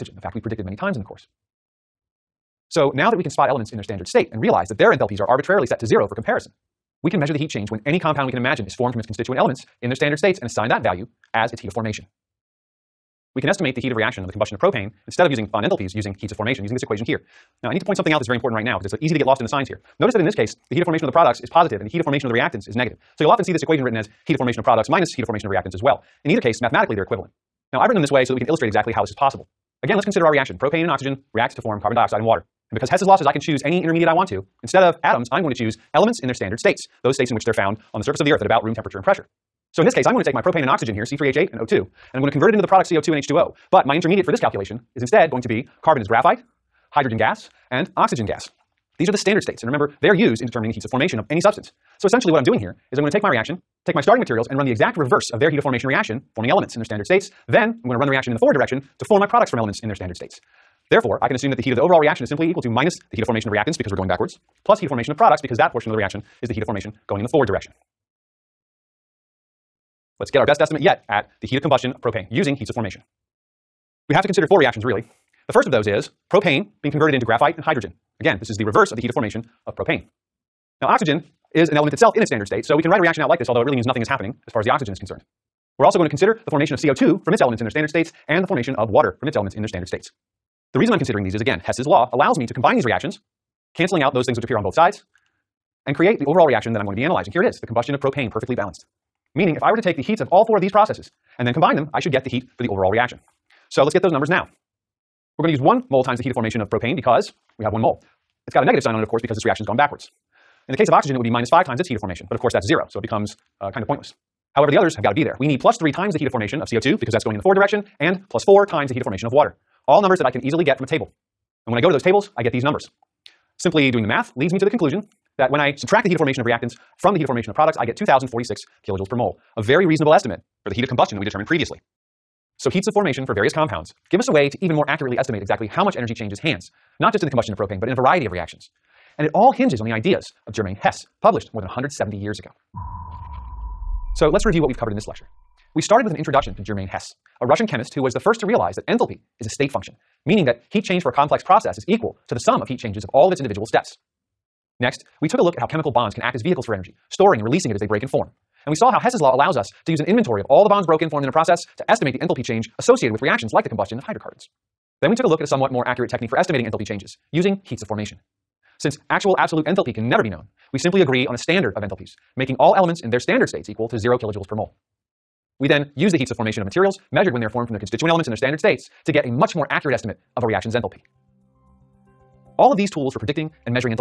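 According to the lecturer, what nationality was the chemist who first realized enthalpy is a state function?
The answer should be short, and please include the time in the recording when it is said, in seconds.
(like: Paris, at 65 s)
Russian, at 147 s.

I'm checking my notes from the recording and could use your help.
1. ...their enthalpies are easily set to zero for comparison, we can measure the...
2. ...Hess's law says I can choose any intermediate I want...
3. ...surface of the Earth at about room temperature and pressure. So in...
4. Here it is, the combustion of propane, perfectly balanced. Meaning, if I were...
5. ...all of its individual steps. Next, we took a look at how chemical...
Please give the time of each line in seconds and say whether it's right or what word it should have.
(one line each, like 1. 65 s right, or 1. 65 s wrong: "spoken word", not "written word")
1. 4 s wrong: "arbitrarily", not "easily"
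2. 32 s right
3. 38 s right
4. 97 s right
5. 153 s right.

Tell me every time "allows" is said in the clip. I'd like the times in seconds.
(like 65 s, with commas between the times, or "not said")
92 s, 159 s.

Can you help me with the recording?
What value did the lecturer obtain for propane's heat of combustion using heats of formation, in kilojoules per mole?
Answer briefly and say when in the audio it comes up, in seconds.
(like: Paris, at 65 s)
2,046, at 127 s.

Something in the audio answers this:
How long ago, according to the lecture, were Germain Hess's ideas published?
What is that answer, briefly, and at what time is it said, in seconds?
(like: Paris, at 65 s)
More than 170 years, at 141 s.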